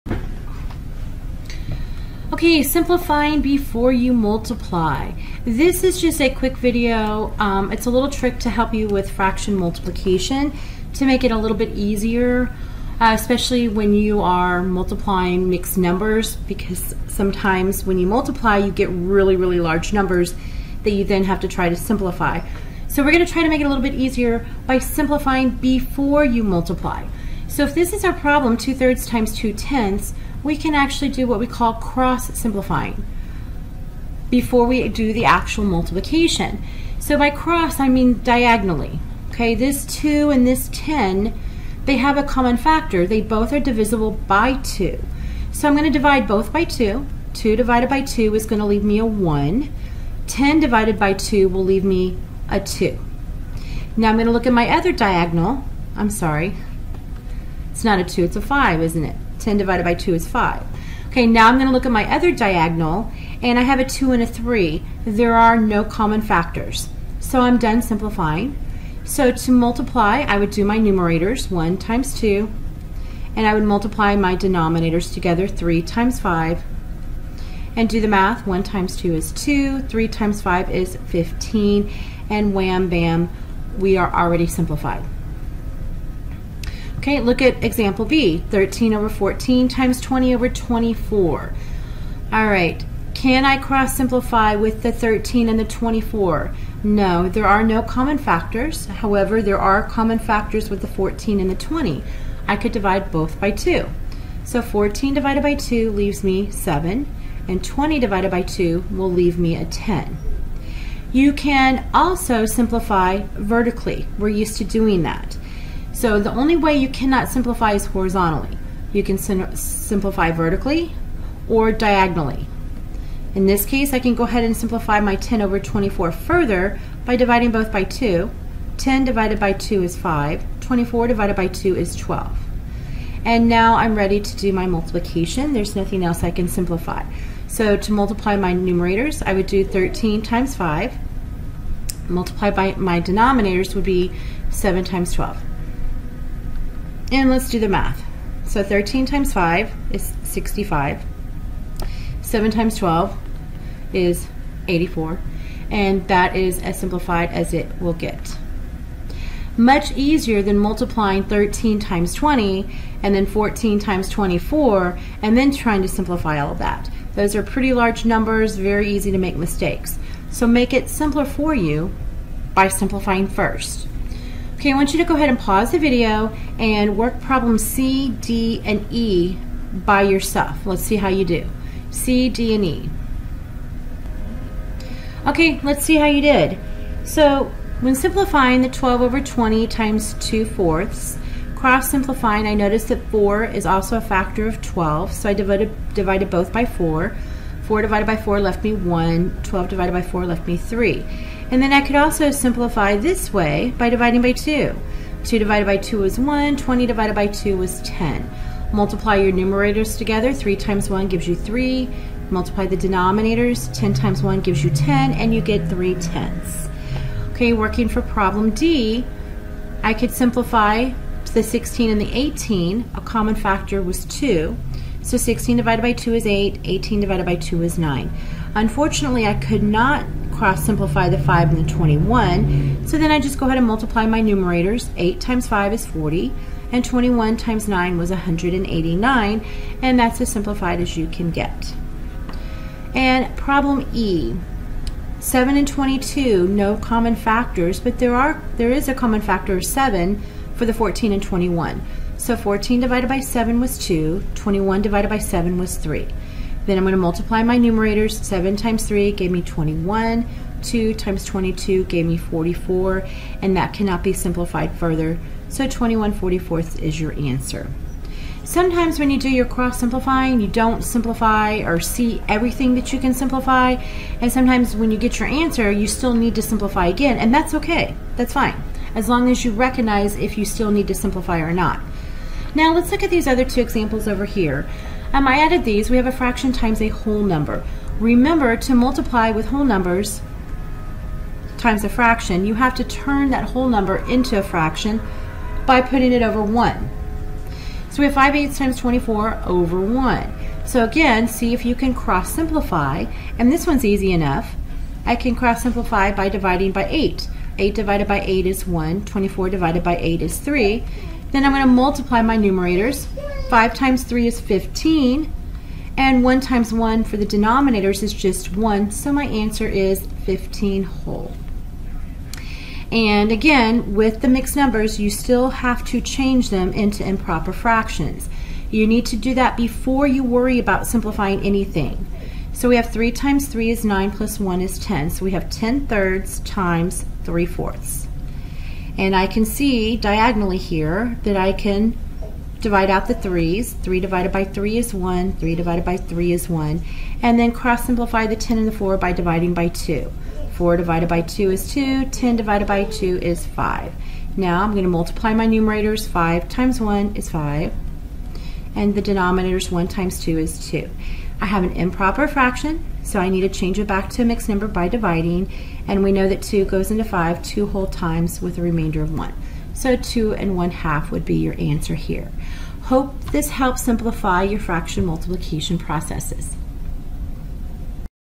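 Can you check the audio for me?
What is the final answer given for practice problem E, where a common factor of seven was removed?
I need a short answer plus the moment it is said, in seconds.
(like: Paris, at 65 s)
21/44, at 265 s.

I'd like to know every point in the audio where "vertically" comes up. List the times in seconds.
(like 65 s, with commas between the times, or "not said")
113 s, 120 s.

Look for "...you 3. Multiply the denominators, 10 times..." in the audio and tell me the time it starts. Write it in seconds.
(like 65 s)
211 s.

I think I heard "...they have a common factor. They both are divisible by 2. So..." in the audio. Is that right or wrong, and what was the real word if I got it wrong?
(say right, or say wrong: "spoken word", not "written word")
right.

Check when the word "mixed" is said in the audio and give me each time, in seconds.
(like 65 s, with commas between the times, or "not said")
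15 s, 324 s, 364 s.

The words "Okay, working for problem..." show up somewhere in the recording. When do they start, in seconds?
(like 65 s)
217 s.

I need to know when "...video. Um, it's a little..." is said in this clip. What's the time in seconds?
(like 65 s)
6 s.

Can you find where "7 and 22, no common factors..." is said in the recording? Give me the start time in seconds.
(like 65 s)
245 s.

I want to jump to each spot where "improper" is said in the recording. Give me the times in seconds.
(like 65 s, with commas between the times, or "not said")
327 s, 361 s.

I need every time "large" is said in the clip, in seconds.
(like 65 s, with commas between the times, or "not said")
19 s, 167 s.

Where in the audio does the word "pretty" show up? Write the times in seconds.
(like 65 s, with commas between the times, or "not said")
167 s.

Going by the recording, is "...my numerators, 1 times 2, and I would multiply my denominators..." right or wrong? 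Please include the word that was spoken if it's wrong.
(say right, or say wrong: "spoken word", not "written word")
right.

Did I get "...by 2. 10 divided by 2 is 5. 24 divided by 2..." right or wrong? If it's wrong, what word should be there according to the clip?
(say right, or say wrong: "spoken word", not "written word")
right.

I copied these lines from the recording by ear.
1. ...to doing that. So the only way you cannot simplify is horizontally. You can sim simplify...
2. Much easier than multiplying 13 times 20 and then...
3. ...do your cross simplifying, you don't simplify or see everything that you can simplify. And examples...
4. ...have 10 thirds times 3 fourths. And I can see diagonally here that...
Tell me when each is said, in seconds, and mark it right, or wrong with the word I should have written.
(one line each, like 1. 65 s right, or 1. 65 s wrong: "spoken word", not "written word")
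1. 114 s right
2. 159 s right
3. 269 s wrong: "sometimes", not "examples"
4. 335 s right.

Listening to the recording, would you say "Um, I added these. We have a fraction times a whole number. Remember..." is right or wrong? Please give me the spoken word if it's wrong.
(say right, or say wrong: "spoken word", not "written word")
right.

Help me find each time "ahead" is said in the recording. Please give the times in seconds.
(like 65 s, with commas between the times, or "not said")
124 s, 175 s, 233 s.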